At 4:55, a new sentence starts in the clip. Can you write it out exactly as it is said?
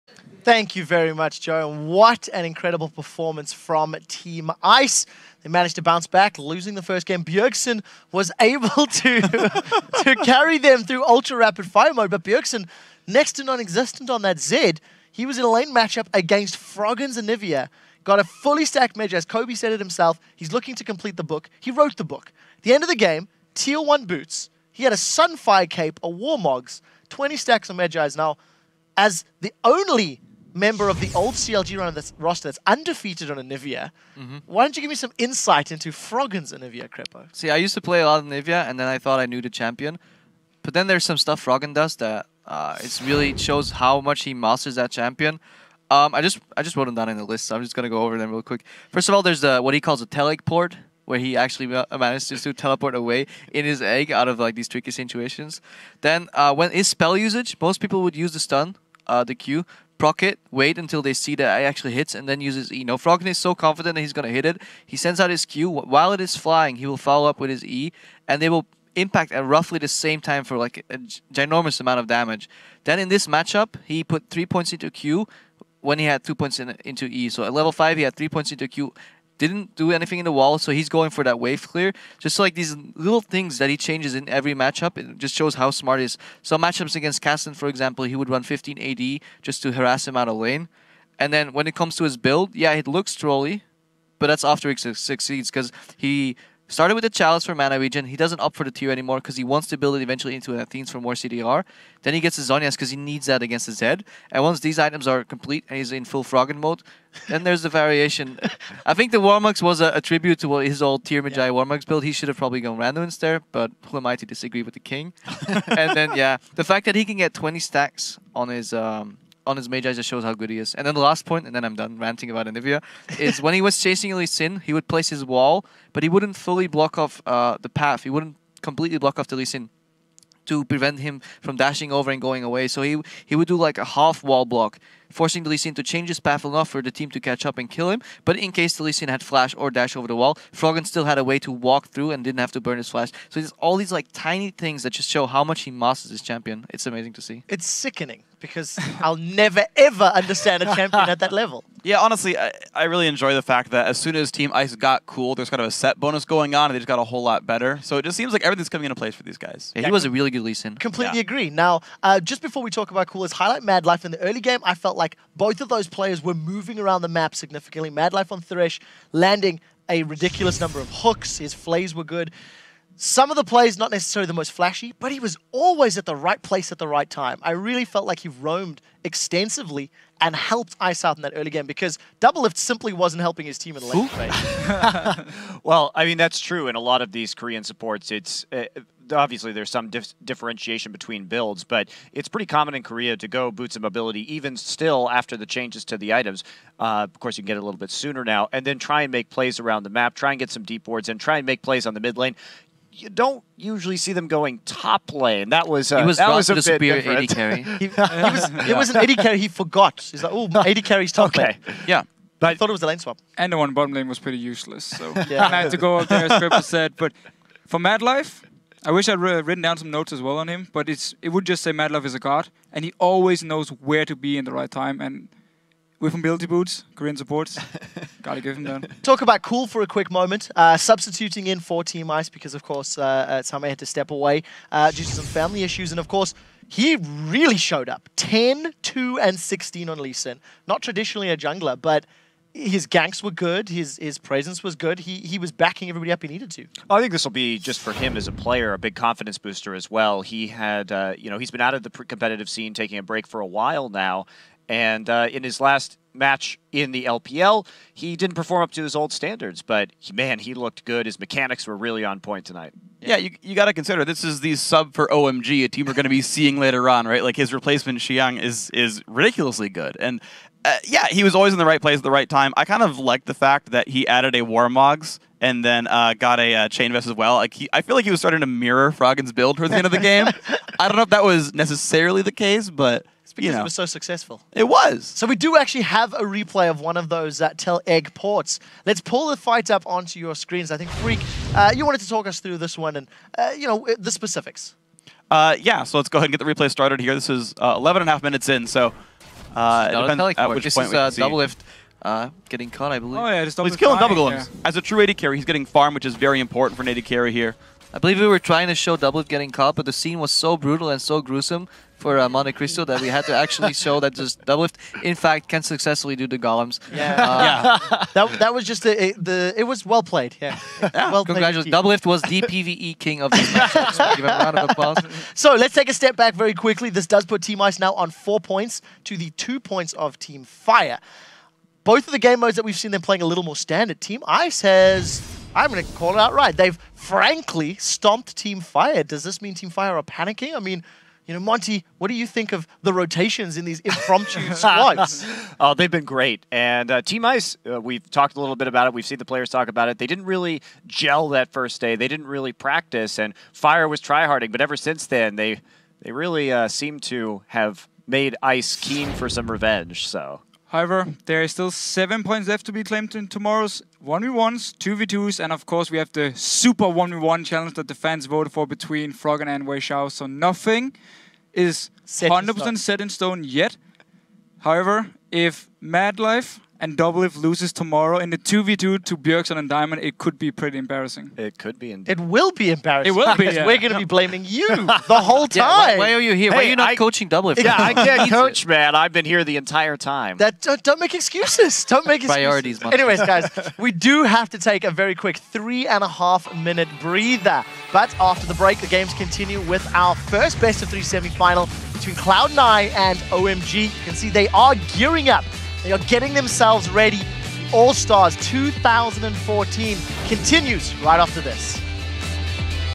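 Uh, yeah, so let's go ahead and get the replay started here.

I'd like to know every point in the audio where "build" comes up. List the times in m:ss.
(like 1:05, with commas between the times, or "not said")
1:32, 1:39, 1:51, 3:11, 4:39.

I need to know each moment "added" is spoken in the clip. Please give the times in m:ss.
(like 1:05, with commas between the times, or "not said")
4:34.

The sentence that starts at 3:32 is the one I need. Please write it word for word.
I thought it was the lane swap.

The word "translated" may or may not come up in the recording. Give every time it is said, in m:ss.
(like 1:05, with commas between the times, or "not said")
not said.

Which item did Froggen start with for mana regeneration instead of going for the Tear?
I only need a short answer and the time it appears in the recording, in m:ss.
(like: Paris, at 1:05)
Chalice, at 1:37.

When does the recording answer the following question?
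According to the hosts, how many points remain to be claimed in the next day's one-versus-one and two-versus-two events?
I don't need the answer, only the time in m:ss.
6:01.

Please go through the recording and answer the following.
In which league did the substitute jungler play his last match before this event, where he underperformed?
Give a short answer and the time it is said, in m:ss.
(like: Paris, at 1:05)
LPL, at 4:17.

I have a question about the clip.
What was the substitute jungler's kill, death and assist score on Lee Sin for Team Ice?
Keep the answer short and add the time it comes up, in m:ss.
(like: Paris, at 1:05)
10, 2, and 16, at 3:58.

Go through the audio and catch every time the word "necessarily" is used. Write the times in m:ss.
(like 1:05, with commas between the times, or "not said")
2:53, 4:41.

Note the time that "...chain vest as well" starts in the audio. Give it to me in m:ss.
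4:36.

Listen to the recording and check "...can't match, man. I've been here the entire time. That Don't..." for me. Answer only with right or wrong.
wrong.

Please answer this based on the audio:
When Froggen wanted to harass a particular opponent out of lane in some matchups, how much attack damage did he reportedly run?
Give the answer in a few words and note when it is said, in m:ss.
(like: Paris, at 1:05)
15 AD, at 1:28.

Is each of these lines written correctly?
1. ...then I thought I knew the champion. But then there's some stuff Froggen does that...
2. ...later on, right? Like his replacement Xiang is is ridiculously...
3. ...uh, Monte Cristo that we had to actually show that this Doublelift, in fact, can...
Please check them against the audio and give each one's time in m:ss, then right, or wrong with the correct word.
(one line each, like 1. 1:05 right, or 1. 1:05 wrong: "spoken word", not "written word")
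1. 0:38 right
2. 4:26 right
3. 5:12 right.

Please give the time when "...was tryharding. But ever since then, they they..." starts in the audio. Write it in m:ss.
5:53.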